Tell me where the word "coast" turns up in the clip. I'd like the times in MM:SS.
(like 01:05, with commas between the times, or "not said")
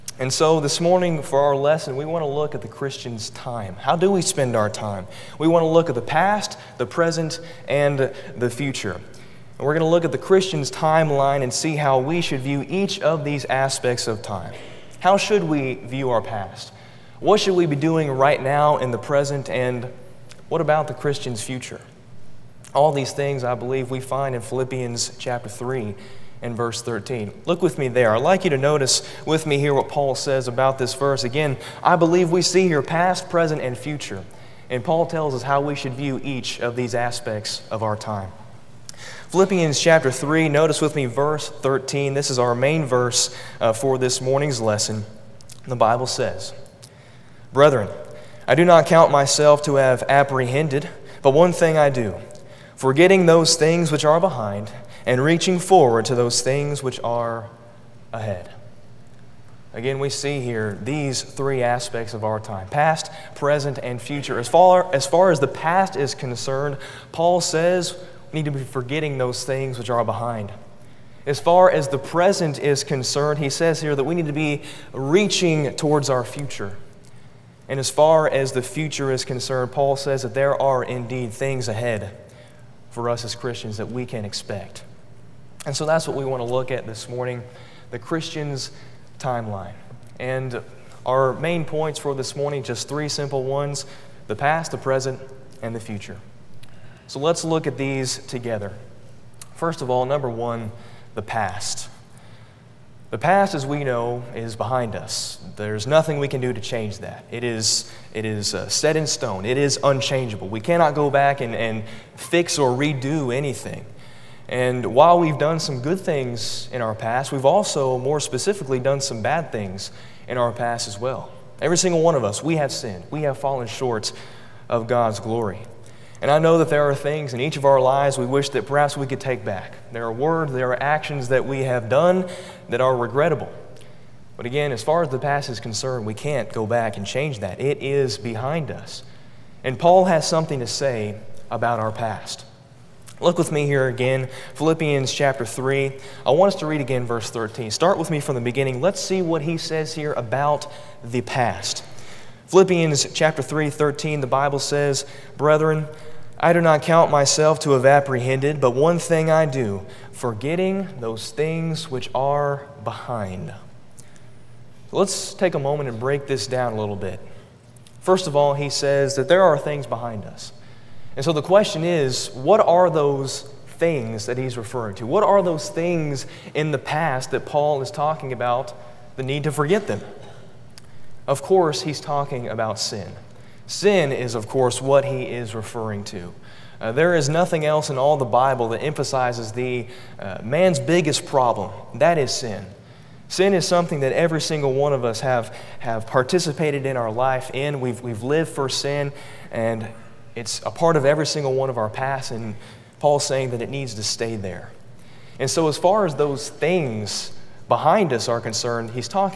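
not said.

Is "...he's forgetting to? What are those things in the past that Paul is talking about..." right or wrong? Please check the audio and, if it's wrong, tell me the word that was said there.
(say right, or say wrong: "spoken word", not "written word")
wrong: "referring", not "forgetting".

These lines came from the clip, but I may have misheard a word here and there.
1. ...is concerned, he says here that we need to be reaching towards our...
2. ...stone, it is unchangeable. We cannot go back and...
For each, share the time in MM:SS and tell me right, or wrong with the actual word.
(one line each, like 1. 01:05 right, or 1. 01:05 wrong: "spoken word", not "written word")
1. 01:12 right
2. 01:49 right.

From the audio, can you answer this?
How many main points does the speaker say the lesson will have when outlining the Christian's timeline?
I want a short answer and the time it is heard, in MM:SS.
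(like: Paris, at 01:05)
3, at 01:32.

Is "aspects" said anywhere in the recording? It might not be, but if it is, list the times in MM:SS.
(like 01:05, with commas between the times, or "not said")
00:13, 00:36, 01:01.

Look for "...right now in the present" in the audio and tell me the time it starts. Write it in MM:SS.
00:18.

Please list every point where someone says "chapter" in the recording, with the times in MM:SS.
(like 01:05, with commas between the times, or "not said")
00:25, 00:39, 02:25, 02:33.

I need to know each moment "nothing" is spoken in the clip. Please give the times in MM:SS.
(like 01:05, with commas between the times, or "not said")
01:45, 03:07.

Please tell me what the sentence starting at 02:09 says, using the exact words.
There are words, there are actions that we have done that are regrettable.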